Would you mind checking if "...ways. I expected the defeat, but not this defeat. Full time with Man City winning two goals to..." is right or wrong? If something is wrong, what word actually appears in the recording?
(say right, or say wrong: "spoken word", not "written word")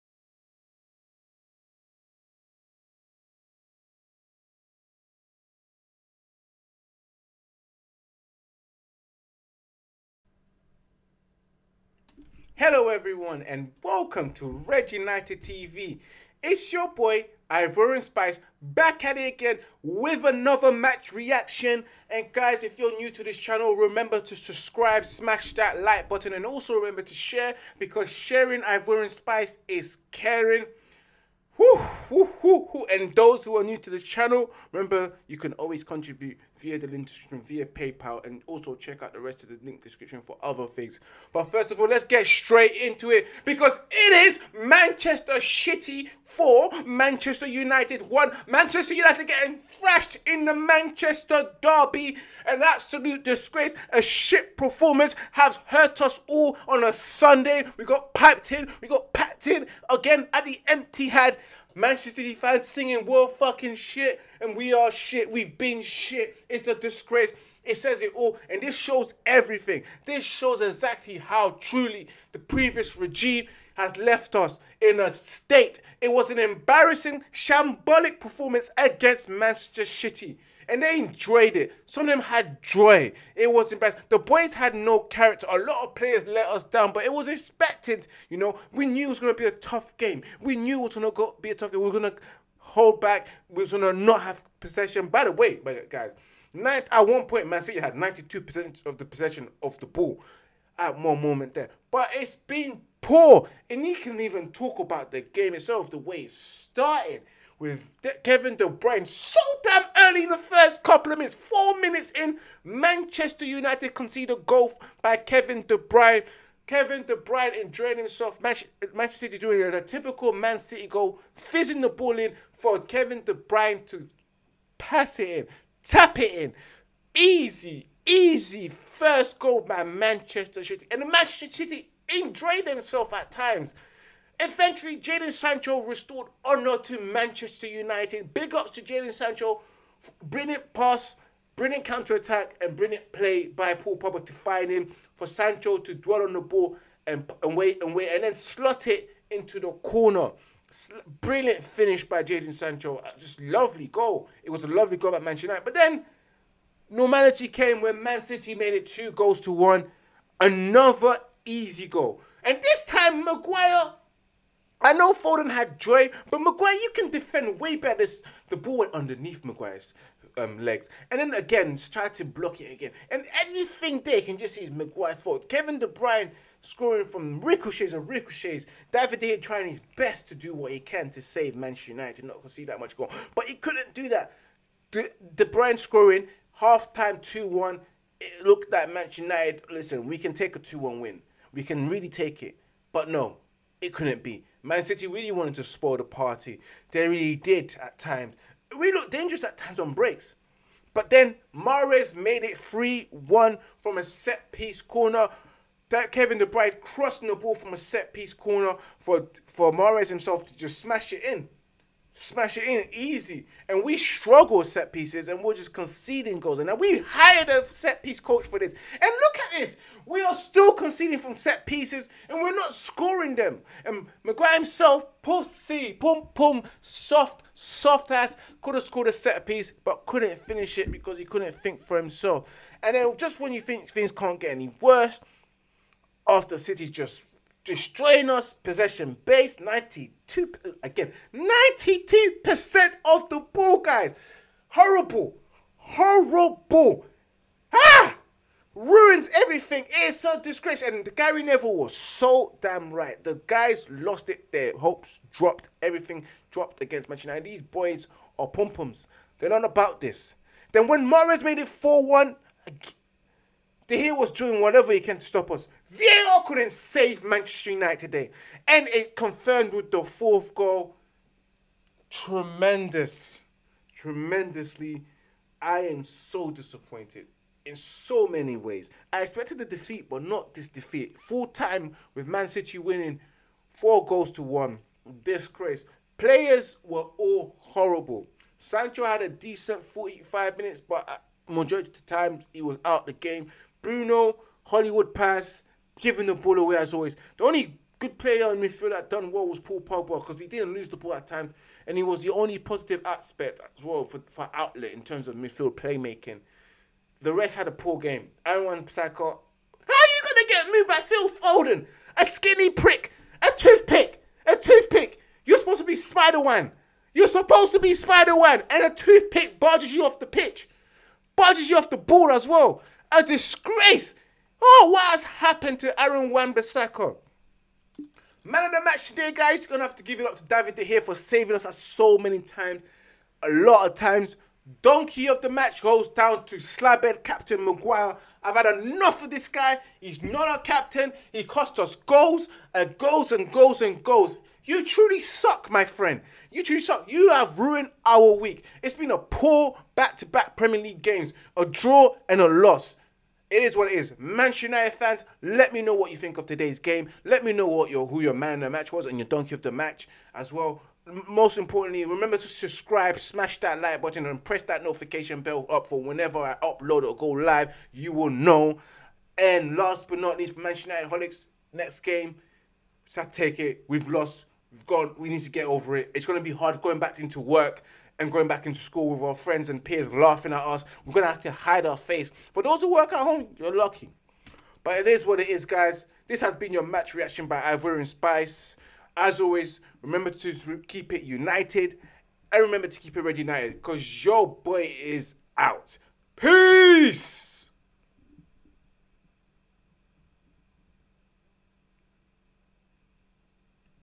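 wrong: "four", not "two".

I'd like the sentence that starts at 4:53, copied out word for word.
Bruno, Hollywood pass, giving the ball away as always.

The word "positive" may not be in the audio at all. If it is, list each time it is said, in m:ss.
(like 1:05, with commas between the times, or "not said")
5:02.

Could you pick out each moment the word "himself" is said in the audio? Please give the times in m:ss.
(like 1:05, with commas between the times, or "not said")
1:57, 3:30, 3:44, 3:51.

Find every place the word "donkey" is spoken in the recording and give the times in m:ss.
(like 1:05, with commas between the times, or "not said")
5:34, 5:59.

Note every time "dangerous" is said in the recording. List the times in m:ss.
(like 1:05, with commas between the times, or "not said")
3:19.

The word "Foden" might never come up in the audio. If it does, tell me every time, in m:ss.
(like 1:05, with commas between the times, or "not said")
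2:45, 5:11.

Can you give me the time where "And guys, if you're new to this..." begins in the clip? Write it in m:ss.
0:22.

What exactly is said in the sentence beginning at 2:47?
This, the ball went underneath Maguire's um, legs.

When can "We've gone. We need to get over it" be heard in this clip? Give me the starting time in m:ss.
6:14.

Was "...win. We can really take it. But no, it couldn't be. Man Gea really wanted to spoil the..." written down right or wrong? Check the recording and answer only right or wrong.
wrong.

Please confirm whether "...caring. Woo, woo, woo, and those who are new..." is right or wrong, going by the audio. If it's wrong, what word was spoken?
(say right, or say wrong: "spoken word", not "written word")
right.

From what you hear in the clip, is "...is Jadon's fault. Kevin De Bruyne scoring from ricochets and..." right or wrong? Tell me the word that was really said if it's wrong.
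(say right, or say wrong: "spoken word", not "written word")
wrong: "Maguire", not "Jadon".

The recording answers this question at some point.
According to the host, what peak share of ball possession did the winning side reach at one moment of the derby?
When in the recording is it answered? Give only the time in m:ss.
1:37.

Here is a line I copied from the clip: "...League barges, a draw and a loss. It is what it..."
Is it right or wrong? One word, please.
wrong.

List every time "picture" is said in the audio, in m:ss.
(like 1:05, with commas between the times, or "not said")
not said.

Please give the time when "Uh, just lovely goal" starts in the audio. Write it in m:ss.
2:32.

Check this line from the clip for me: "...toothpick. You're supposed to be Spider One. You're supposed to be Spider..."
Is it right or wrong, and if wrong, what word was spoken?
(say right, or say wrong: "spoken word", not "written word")
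right.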